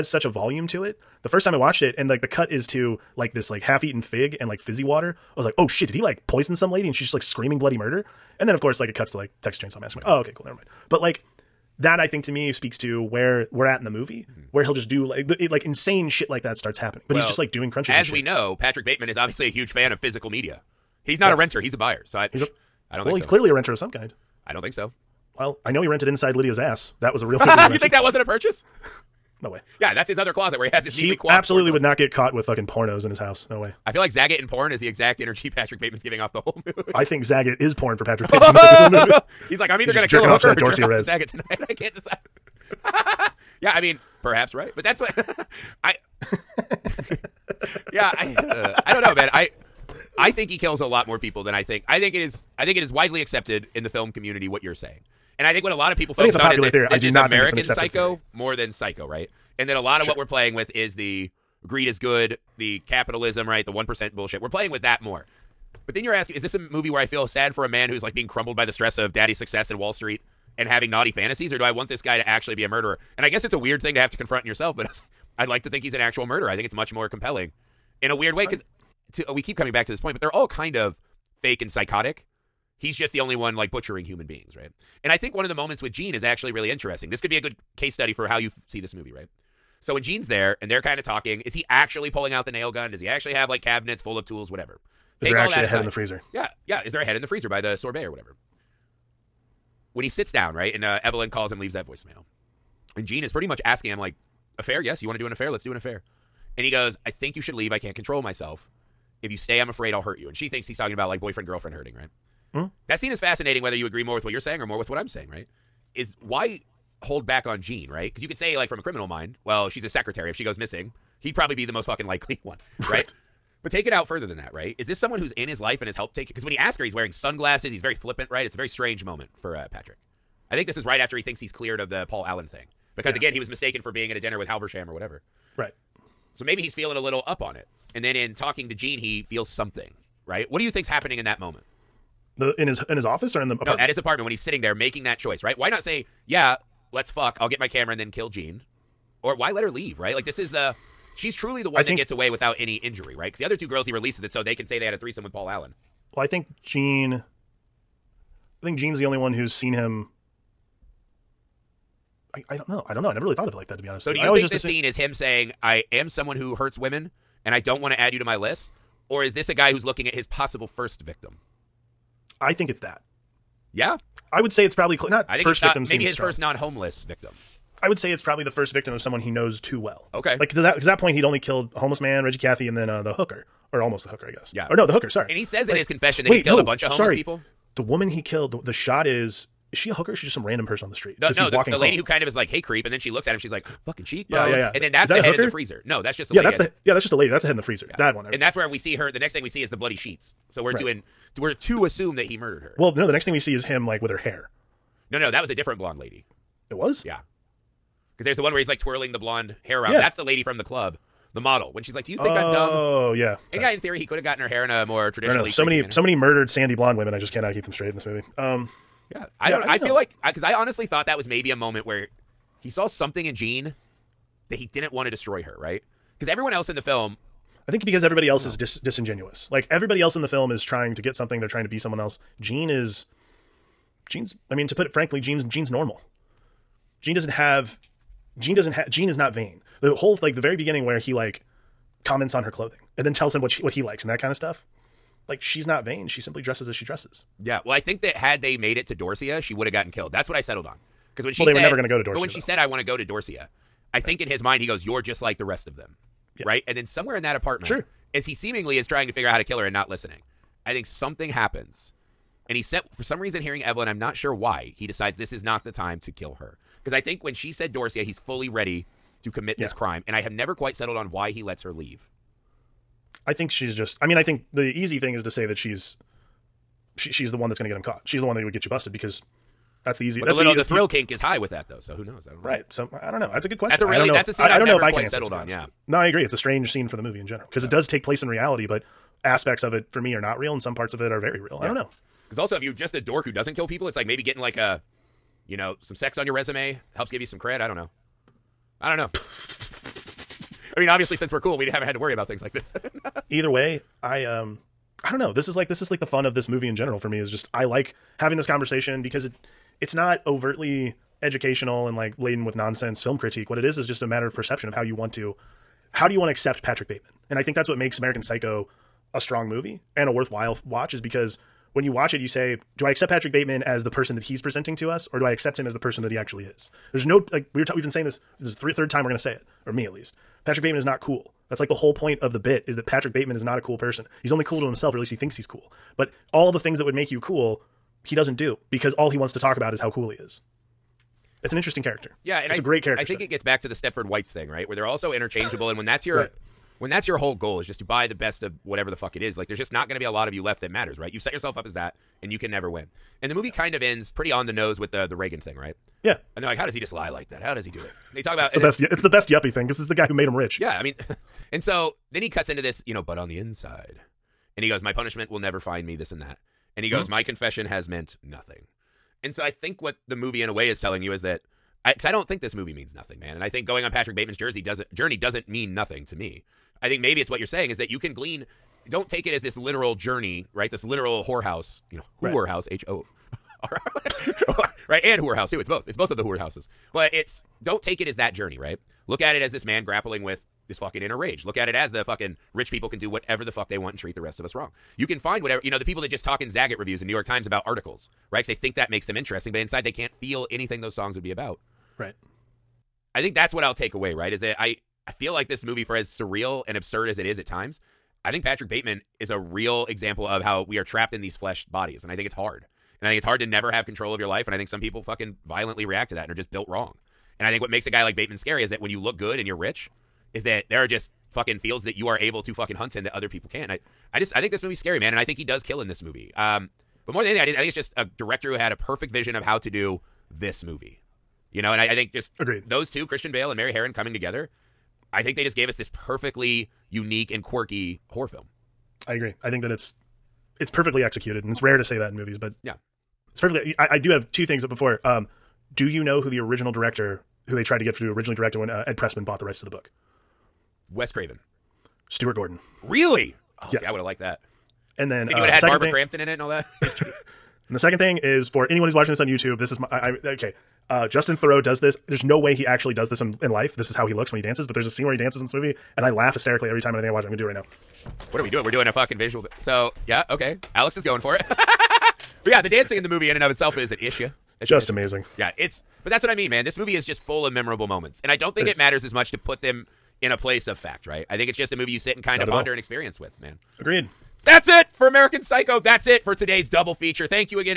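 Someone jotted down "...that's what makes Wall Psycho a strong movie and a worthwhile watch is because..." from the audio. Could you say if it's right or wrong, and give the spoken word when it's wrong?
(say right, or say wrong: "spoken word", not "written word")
wrong: "American", not "Wall".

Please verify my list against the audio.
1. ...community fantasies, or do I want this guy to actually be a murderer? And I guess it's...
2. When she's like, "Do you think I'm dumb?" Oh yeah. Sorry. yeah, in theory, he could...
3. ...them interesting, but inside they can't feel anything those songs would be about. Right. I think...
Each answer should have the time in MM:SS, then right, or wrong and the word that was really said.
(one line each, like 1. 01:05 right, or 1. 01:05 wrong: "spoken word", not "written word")
1. 01:10 wrong: "naughty", not "community"
2. 03:31 right
3. 06:39 right.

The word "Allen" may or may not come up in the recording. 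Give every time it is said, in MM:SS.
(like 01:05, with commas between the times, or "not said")
02:12, 02:35.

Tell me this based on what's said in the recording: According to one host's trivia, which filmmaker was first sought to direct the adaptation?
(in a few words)
Stuart Gordon.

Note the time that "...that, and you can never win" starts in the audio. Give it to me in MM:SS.
05:51.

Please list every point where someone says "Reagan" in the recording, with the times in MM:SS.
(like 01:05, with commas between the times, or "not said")
05:55.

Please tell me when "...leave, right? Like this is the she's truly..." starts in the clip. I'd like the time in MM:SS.
02:29.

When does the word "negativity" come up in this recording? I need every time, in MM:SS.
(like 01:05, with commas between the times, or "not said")
not said.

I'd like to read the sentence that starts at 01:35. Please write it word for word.
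Is Take there actually a head in the freezer?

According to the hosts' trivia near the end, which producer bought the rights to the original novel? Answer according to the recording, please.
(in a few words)
Ed Pressman.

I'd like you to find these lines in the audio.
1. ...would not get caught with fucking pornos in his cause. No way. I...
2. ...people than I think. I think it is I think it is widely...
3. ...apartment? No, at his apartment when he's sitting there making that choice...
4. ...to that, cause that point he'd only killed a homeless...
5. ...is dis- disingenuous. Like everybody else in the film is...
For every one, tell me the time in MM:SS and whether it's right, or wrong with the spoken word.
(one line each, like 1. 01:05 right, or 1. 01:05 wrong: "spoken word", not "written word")
1. 00:31 wrong: "house", not "cause"
2. 00:51 right
3. 02:23 right
4. 03:00 right
5. 03:48 right.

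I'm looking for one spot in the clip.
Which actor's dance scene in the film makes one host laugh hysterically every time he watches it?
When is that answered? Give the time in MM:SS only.
07:41.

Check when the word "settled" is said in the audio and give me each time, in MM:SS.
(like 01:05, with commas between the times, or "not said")
04:10, 04:30, 04:45.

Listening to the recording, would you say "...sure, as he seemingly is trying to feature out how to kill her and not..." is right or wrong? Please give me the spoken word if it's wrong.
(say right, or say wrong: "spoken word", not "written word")
wrong: "figure", not "feature".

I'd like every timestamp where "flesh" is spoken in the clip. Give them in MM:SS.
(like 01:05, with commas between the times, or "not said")
06:51.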